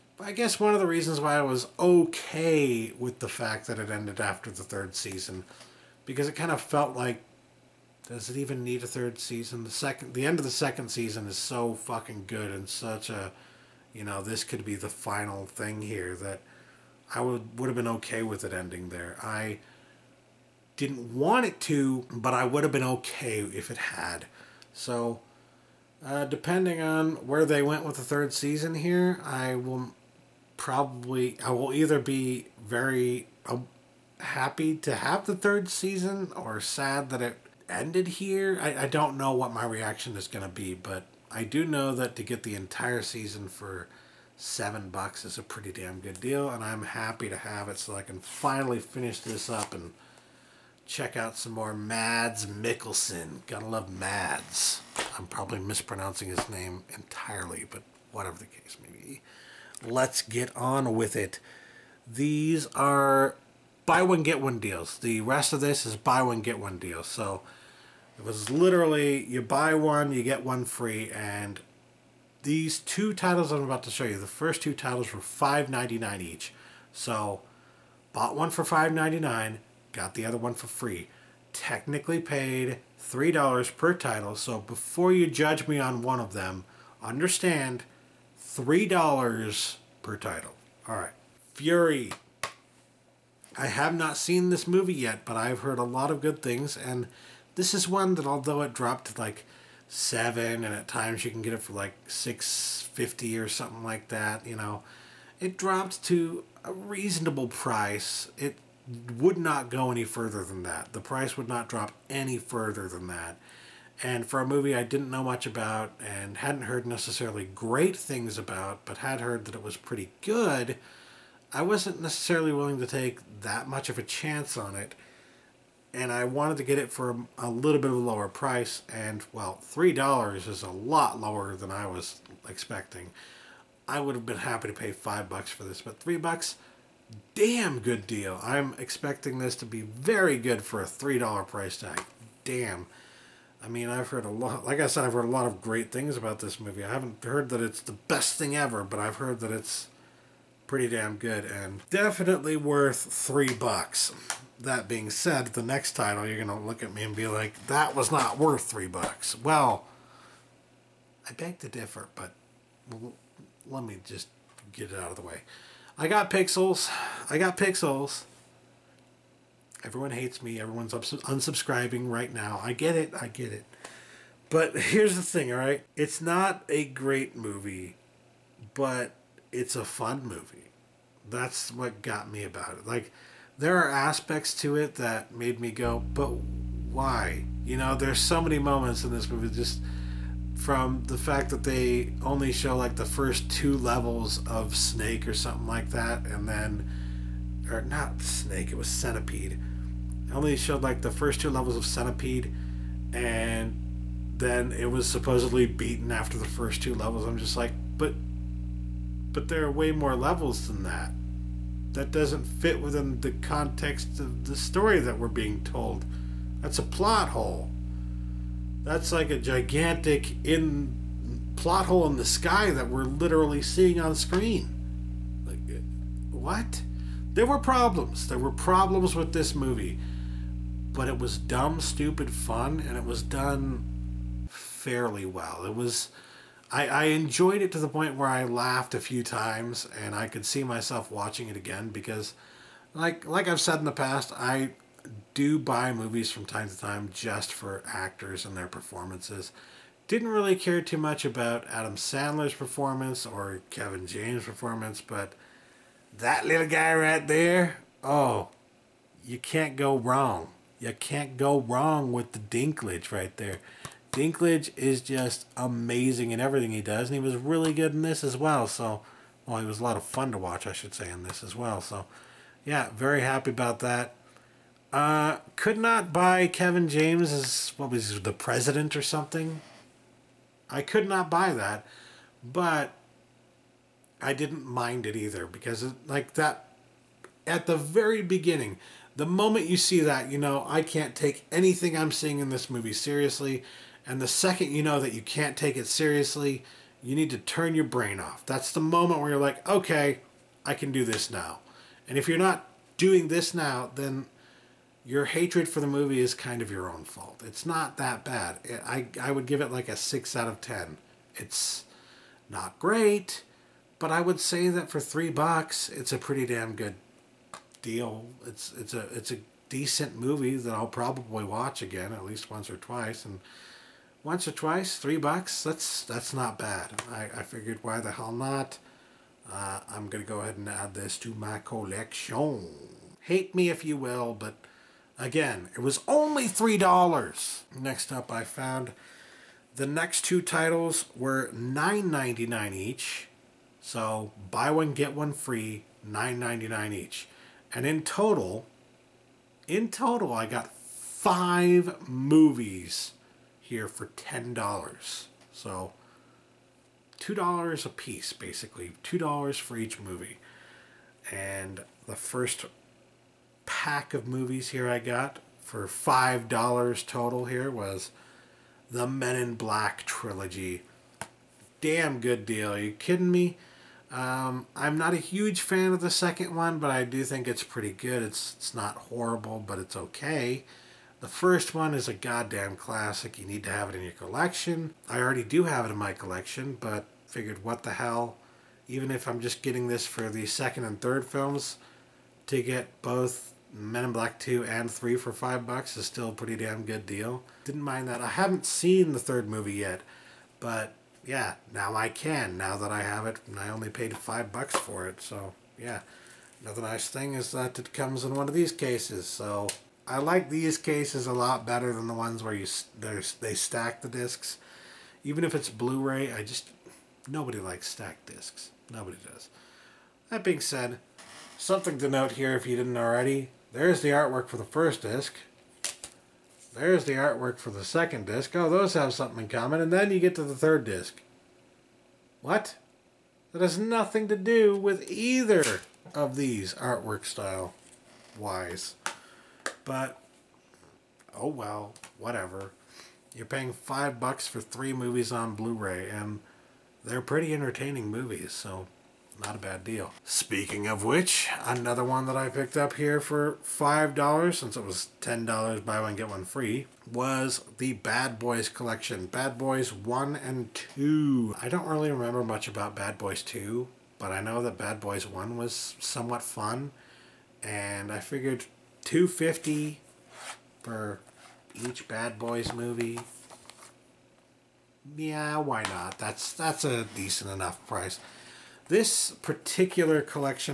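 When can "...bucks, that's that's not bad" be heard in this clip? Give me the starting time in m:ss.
5:25.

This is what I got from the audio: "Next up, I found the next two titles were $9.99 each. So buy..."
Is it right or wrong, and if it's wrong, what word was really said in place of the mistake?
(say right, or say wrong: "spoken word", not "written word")
right.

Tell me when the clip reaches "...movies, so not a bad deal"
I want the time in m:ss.
7:28.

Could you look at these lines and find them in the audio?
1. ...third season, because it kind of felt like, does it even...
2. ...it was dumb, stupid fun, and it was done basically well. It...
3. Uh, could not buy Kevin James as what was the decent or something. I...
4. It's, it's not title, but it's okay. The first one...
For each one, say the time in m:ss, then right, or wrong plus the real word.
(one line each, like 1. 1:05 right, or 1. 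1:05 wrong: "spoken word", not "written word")
1. 0:04 right
2. 3:51 wrong: "fairly", not "basically"
3. 4:34 wrong: "president", not "decent"
4. 6:18 wrong: "horrible", not "title".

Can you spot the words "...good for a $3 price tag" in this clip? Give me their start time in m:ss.
2:20.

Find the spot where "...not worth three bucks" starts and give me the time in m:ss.
2:38.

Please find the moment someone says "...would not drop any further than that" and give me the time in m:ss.
1:51.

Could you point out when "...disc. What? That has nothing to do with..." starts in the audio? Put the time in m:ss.
7:10.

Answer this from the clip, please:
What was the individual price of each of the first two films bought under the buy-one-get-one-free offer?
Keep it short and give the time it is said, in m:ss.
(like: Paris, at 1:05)
$5.99, at 1:15.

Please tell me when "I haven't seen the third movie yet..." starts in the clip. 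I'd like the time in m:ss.
6:38.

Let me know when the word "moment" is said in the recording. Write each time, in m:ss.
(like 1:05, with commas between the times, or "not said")
3:08, 4:49, 4:58.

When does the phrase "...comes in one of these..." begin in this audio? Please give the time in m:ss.
6:47.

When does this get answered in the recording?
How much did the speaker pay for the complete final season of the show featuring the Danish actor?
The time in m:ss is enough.
0:44.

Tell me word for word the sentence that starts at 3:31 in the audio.
That doesn't fit within the context of the story that we're being told.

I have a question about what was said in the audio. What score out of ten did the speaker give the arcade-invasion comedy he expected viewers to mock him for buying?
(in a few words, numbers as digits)
6 out of 10.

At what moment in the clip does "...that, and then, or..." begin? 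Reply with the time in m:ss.
3:15.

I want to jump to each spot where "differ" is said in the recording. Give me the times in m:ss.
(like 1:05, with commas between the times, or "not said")
2:41.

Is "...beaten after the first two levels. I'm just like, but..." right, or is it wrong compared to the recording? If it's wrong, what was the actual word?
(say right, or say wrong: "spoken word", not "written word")
right.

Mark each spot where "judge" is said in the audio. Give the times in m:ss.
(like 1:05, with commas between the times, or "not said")
1:25.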